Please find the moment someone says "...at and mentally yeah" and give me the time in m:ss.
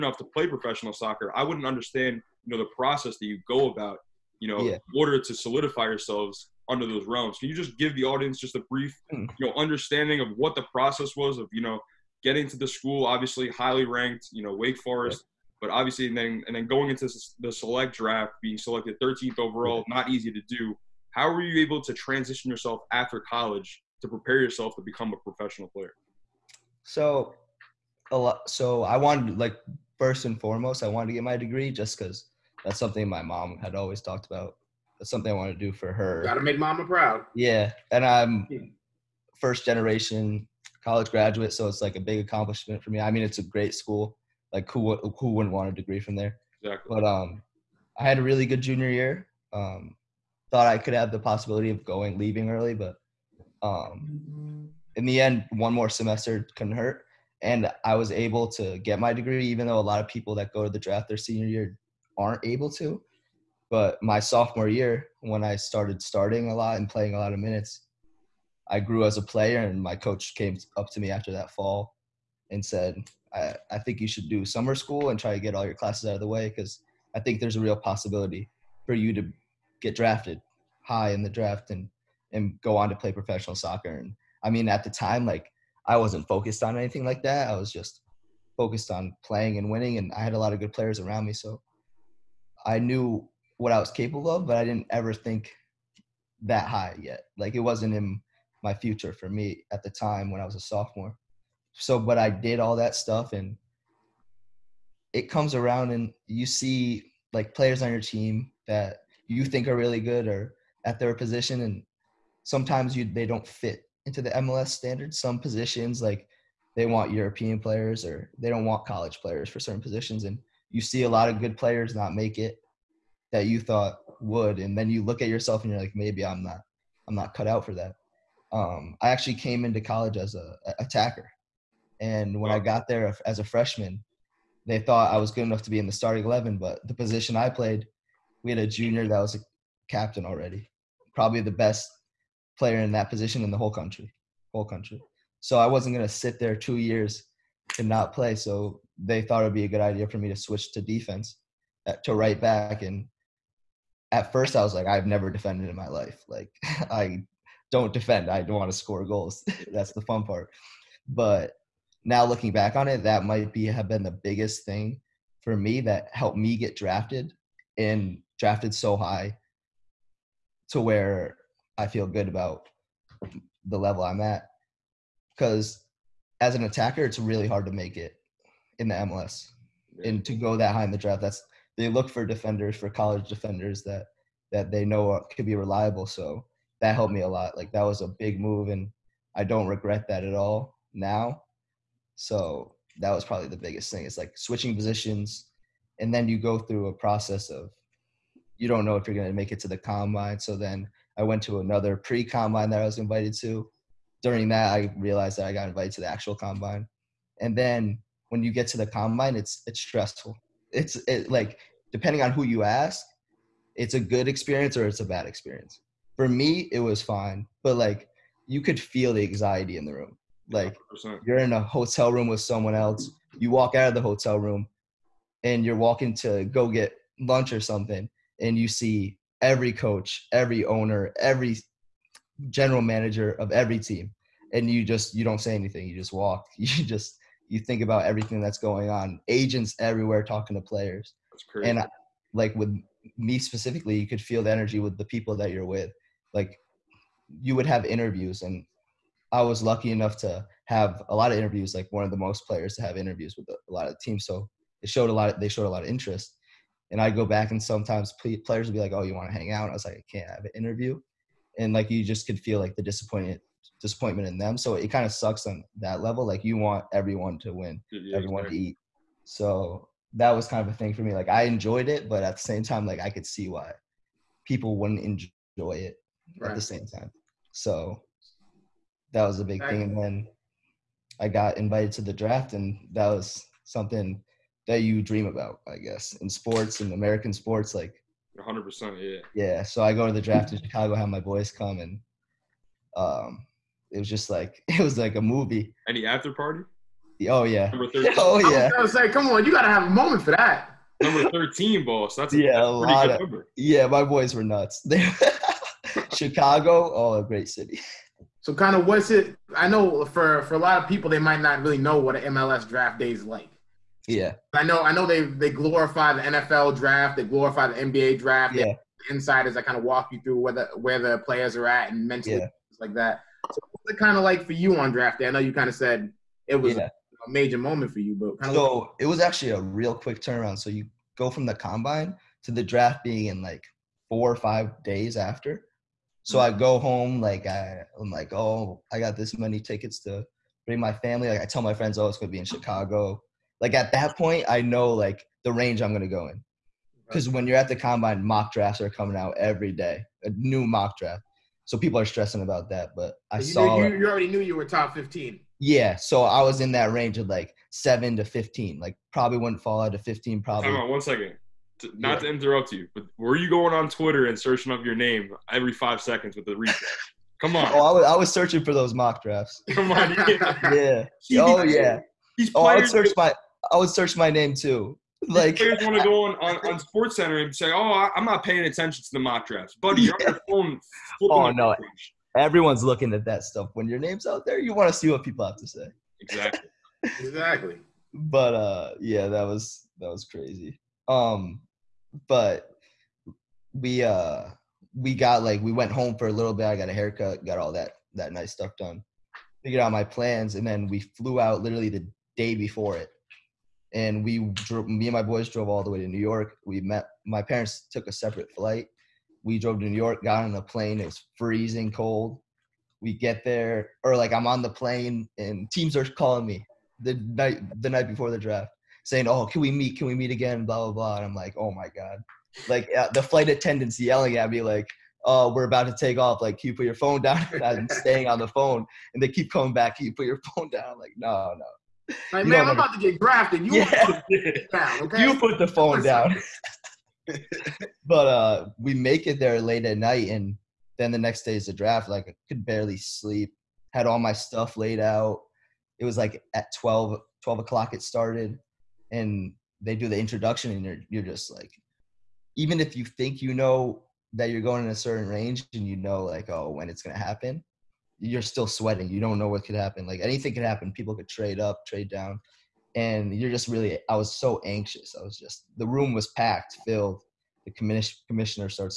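5:21.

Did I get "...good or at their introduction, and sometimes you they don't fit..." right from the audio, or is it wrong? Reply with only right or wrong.
wrong.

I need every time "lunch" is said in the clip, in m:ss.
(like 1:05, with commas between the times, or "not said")
3:47.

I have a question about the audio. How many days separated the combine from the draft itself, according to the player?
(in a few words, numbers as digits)
4 or 5 days.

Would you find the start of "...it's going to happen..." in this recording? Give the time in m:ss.
7:36.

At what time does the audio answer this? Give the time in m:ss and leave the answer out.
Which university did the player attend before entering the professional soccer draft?
0:14.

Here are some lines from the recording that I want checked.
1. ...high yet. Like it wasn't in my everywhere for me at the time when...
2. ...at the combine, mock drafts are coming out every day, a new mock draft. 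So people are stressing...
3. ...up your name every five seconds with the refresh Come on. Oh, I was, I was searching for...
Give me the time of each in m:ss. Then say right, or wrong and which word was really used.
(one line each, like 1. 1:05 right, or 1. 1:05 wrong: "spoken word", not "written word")
1. 1:36 wrong: "future", not "everywhere"
2. 5:47 right
3. 6:04 right.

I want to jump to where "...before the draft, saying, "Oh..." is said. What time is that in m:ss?
6:58.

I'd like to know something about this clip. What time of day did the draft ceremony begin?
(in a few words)
12 o'clock.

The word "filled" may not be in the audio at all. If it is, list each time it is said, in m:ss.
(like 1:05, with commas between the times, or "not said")
7:46.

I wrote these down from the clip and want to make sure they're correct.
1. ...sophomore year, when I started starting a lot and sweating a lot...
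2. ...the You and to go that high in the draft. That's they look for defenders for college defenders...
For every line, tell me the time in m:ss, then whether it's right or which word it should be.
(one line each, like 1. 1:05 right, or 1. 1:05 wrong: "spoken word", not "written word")
1. 1:04 wrong: "playing", not "sweating"
2. 2:58 wrong: "MLS", not "You".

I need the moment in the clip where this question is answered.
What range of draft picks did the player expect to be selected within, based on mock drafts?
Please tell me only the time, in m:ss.
5:57.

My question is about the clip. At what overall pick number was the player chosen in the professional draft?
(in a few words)
13th.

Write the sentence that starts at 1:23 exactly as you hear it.
And I mean, at the time, like I wasn't focused on anything like that.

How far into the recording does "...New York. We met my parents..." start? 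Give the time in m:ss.
6:46.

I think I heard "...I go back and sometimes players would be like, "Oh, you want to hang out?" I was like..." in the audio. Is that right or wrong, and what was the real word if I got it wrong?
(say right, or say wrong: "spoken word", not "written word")
right.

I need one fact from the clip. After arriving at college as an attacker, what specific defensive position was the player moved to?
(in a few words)
Right back.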